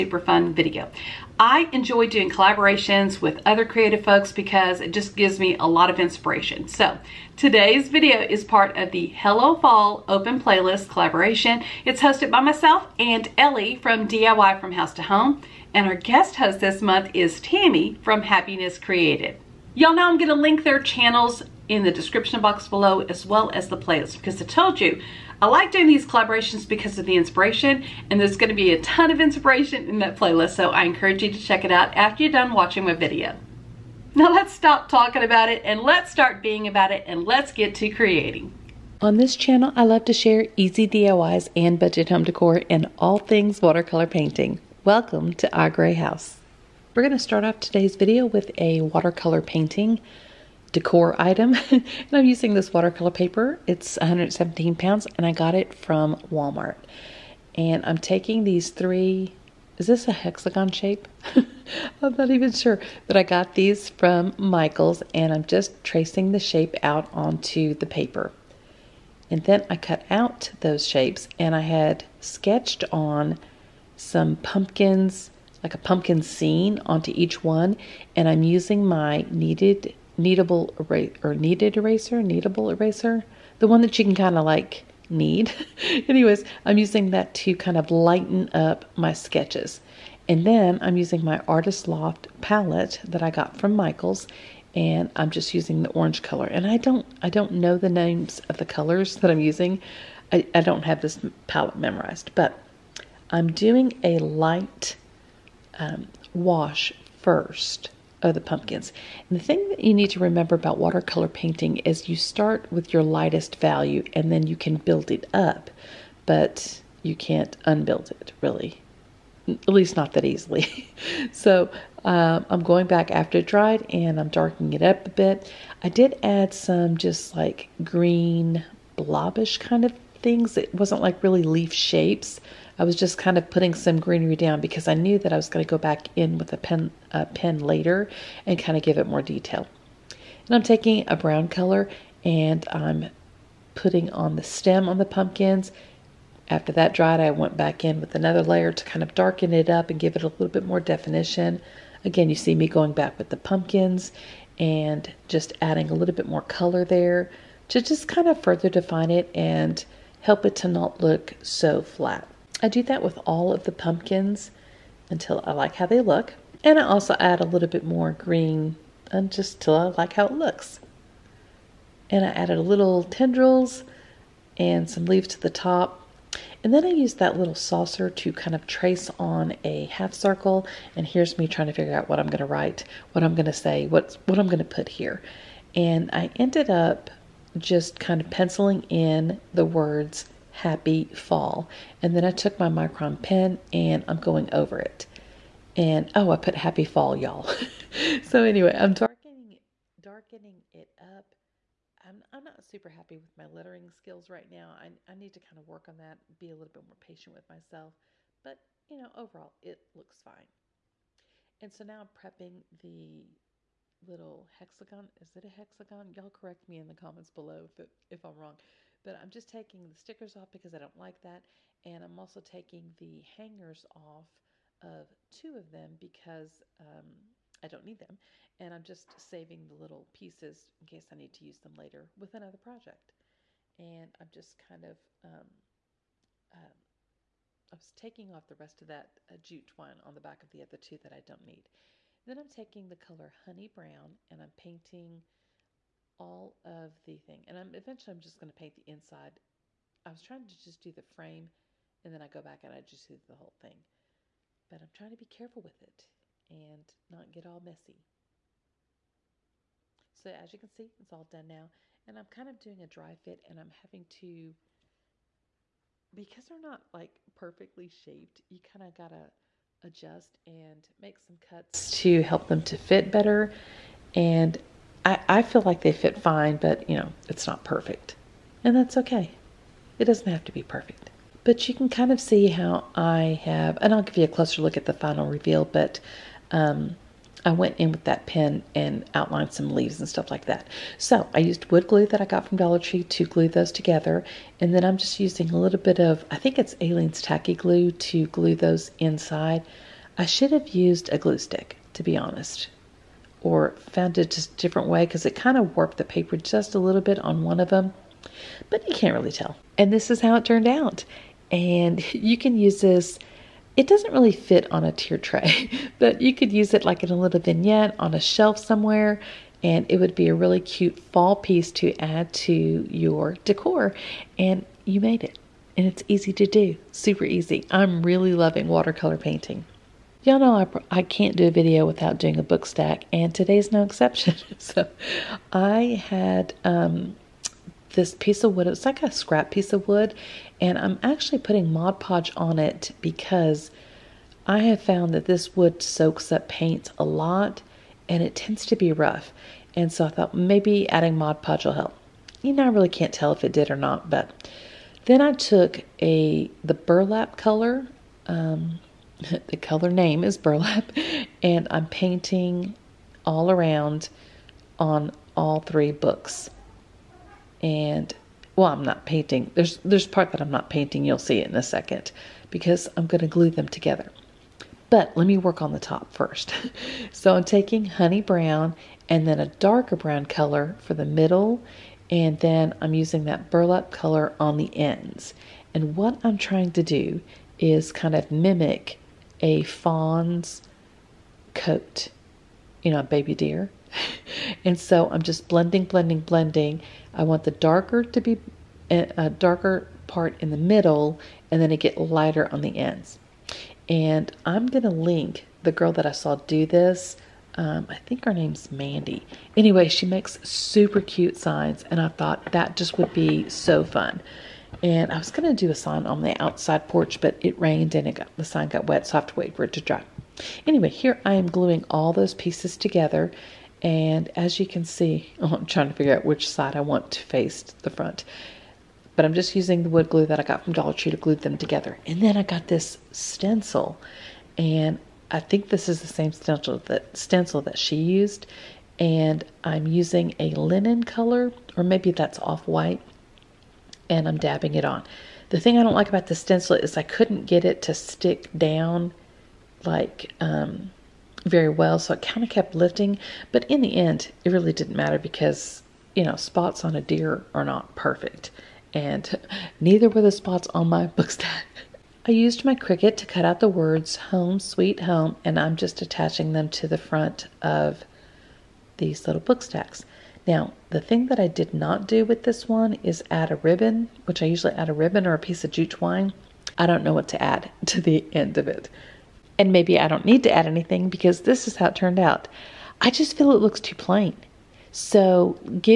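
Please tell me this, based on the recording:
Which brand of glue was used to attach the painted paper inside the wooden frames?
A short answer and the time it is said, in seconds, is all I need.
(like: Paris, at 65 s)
Aleene's Tacky Glue, at 296 s.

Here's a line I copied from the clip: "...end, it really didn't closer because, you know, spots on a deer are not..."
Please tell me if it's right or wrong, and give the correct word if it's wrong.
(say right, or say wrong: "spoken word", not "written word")
wrong: "matter", not "closer".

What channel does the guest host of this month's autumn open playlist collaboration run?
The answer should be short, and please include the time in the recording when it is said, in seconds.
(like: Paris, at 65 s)
Happiness Created, at 18 s.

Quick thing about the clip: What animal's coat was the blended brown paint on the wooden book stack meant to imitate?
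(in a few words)
baby deer.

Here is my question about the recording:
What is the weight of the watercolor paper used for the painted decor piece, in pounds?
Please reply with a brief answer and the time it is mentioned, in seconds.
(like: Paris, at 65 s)
117, at 53 s.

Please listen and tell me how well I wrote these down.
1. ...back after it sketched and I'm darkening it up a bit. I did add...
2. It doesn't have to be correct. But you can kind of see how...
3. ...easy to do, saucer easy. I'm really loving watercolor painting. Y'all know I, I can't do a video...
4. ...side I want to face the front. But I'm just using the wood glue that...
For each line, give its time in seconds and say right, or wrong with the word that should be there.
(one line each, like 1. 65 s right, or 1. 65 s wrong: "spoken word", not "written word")
1. 122 s wrong: "dried", not "sketched"
2. 279 s wrong: "perfect", not "correct"
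3. 326 s wrong: "super", not "saucer"
4. 426 s right.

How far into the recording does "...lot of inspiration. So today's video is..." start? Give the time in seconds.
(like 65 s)
5 s.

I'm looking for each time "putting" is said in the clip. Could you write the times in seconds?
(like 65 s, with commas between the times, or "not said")
133 s, 143 s, 341 s.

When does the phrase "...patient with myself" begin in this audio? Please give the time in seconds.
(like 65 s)
206 s.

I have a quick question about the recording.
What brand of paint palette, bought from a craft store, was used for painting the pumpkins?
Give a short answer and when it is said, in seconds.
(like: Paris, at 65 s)
Artist Loft, at 91 s.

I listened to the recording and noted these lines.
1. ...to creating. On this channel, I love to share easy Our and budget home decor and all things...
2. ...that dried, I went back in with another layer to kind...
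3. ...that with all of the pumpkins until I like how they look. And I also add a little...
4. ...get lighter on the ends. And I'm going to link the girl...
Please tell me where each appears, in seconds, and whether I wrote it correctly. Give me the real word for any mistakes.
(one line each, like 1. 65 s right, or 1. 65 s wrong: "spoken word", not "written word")
1. 37 s wrong: "DIYs", not "Our"
2. 146 s right
3. 162 s right
4. 401 s right.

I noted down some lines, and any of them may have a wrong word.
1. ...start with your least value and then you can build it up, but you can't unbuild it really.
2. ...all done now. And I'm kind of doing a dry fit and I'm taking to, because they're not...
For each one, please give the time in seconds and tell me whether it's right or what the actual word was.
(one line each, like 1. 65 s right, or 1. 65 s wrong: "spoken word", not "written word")
1. 112 s wrong: "lightest", not "least"
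2. 261 s wrong: "having", not "taking".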